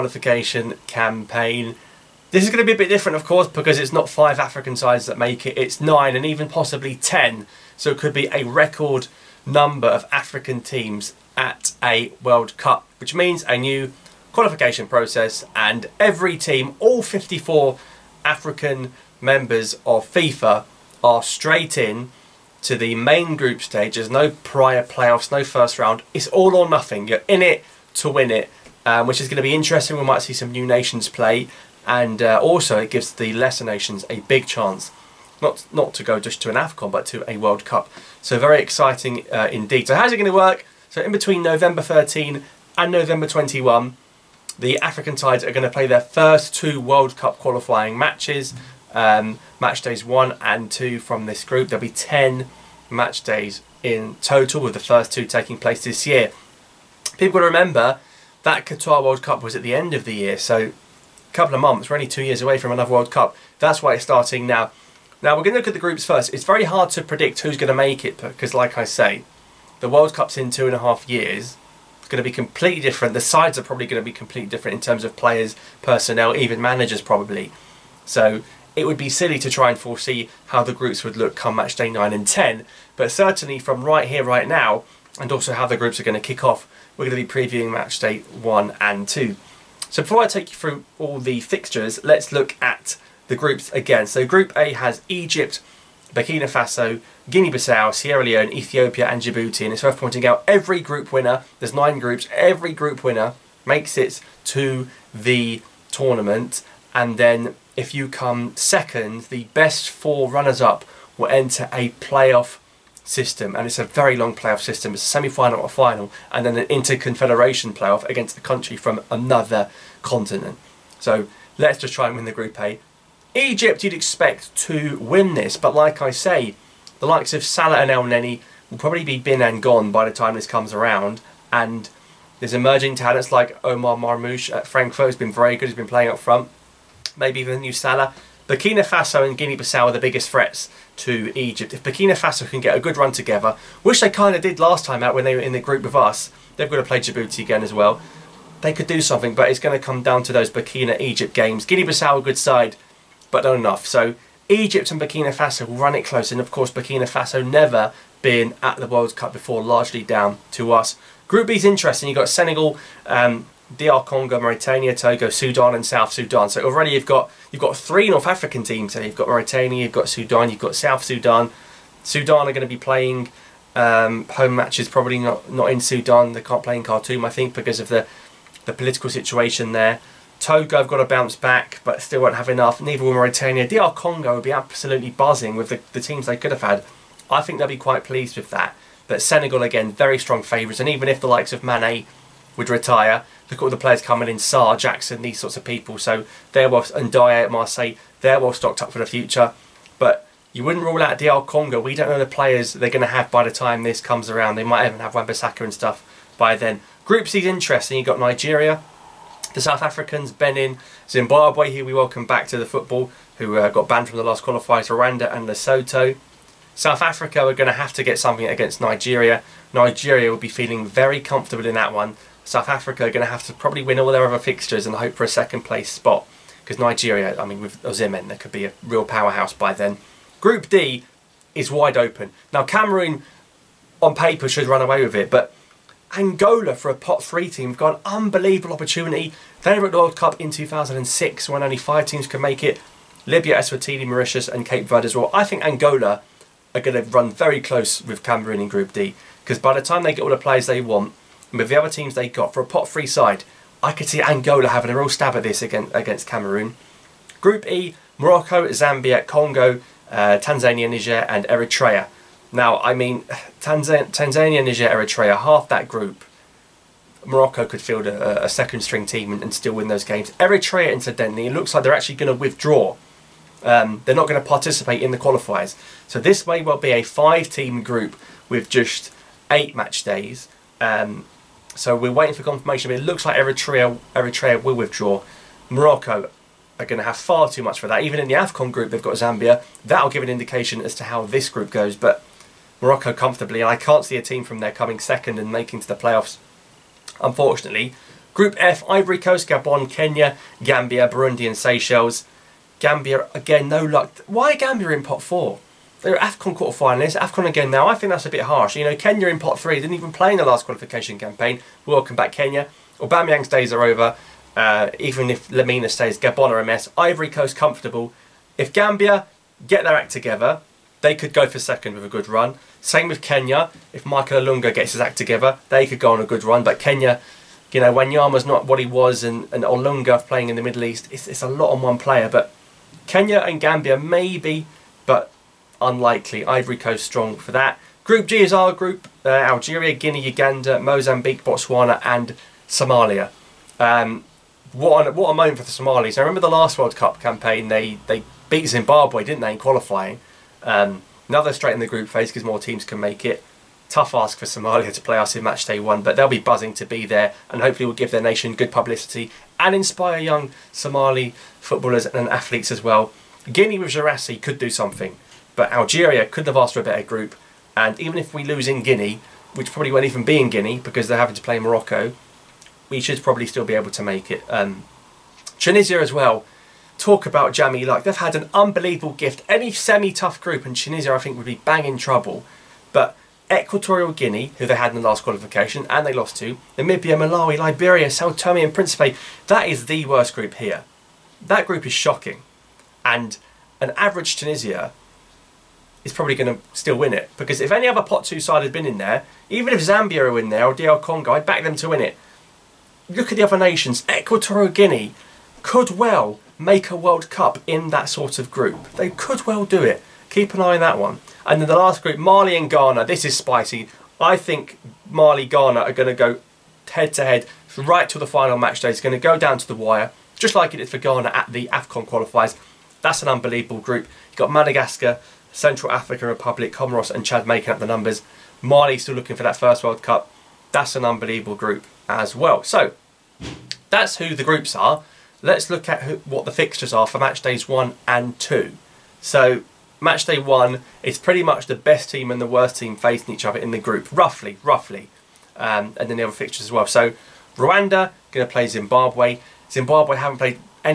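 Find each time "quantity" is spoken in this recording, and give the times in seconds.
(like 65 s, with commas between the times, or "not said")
not said.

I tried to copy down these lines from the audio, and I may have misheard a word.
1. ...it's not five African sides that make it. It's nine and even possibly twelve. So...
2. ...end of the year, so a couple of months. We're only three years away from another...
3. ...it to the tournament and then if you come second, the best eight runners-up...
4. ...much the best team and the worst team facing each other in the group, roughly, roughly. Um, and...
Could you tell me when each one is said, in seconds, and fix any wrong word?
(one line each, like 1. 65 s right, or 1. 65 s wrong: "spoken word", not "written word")
1. 3 s wrong: "ten", not "twelve"
2. 59 s wrong: "two", not "three"
3. 103 s wrong: "four", not "eight"
4. 441 s right.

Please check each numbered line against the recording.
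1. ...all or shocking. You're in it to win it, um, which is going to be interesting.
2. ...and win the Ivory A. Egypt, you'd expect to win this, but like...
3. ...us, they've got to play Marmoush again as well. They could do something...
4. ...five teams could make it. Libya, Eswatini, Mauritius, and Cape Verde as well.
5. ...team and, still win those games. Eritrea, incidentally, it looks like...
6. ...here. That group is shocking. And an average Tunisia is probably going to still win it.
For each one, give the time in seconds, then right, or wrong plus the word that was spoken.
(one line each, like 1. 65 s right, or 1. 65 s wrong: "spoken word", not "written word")
1. 26 s wrong: "nothing", not "shocking"
2. 122 s wrong: "Group", not "Ivory"
3. 145 s wrong: "Djibouti", not "Marmoush"
4. 241 s right
5. 269 s right
6. 390 s right.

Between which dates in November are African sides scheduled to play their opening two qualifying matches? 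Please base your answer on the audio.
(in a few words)
November 13 and November 21.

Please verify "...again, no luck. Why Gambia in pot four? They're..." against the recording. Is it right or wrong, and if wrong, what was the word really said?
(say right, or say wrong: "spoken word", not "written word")
right.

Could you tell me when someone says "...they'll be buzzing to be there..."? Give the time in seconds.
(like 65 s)
356 s.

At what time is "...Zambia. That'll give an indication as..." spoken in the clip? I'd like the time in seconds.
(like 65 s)
289 s.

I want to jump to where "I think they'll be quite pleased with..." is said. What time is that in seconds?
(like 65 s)
187 s.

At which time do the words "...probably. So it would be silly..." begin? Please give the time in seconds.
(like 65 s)
77 s.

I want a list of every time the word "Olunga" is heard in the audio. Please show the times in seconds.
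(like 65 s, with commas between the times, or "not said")
324 s, 329 s.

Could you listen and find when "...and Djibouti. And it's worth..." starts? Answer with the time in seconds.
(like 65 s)
99 s.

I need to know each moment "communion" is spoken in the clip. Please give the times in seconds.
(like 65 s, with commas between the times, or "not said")
not said.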